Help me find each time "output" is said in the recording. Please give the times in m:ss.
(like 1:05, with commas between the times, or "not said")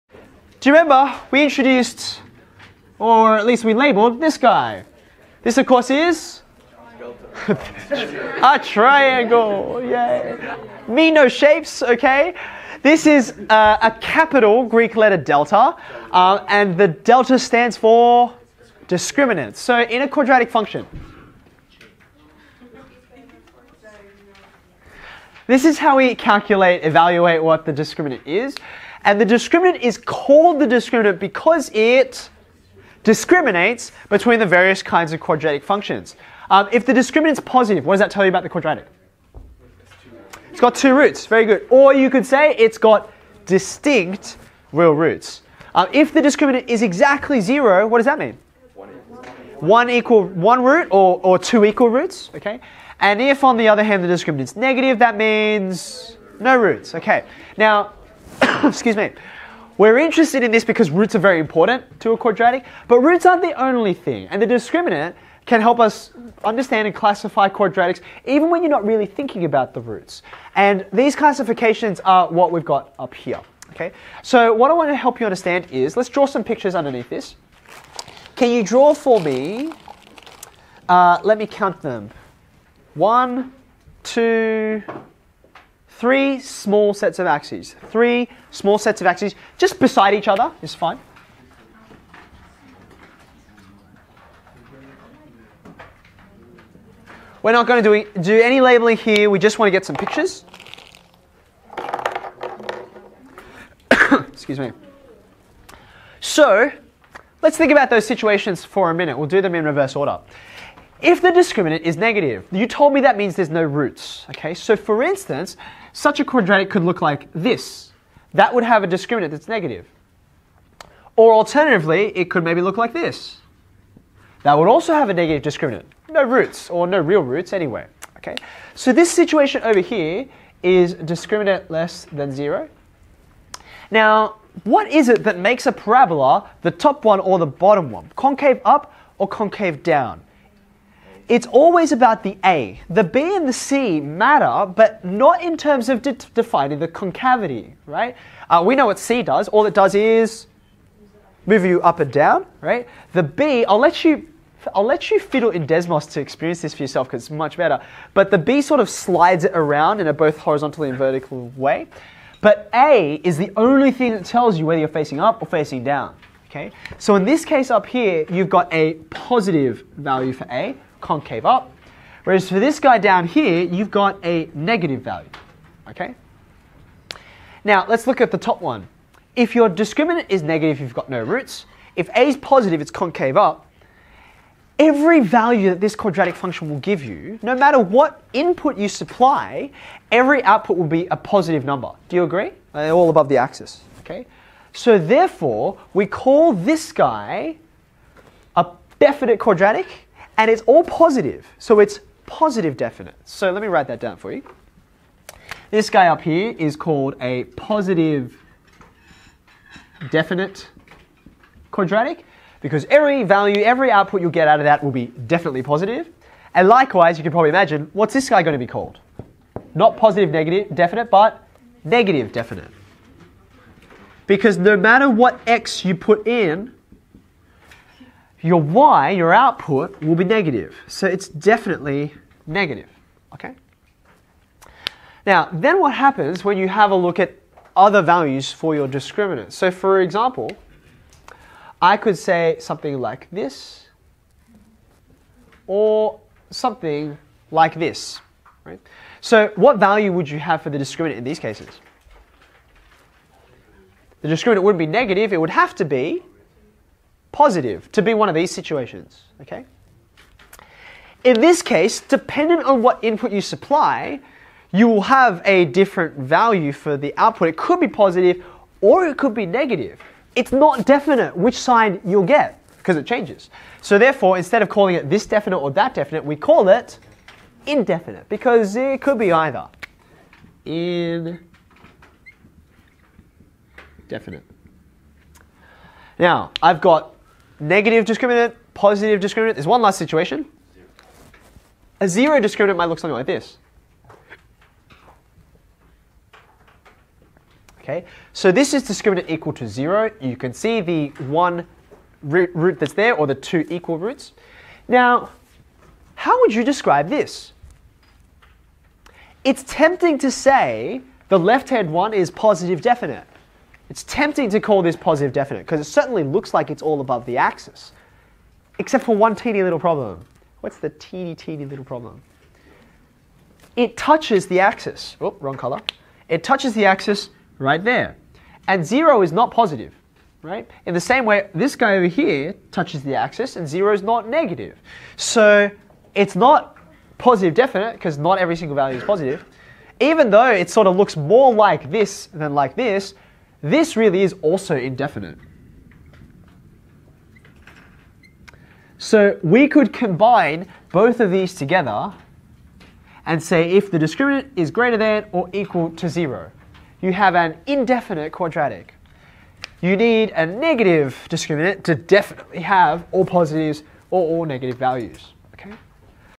3:10, 3:33, 3:49, 4:27.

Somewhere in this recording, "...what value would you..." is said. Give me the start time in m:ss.
4:09.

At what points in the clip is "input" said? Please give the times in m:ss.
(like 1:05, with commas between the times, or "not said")
3:08, 4:23.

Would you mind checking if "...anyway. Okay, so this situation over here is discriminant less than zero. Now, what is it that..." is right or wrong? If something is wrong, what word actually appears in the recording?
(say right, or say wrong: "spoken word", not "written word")
right.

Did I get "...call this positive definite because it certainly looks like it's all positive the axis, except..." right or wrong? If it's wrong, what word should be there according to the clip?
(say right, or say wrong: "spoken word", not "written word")
wrong: "above", not "positive".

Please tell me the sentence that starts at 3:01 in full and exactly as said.
If a is positive, it's concave up.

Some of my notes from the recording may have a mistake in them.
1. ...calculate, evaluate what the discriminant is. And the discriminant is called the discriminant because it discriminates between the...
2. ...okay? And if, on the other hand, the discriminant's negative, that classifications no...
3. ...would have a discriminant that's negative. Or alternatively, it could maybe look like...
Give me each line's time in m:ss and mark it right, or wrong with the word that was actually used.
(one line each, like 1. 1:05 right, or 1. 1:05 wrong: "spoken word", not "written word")
1. 0:26 right
2. 0:52 wrong: "means", not "classifications"
3. 1:58 right.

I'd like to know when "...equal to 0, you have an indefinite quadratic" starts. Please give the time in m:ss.
5:55.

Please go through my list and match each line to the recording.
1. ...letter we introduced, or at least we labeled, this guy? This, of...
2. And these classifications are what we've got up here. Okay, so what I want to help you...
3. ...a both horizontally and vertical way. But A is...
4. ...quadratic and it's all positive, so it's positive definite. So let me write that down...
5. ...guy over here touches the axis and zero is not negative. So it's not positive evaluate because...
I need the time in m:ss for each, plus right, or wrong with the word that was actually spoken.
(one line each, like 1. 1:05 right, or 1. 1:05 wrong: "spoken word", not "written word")
1. 0:00 wrong: "remember", not "letter"
2. 1:10 right
3. 2:40 right
4. 3:19 right
5. 5:31 wrong: "definite", not "evaluate".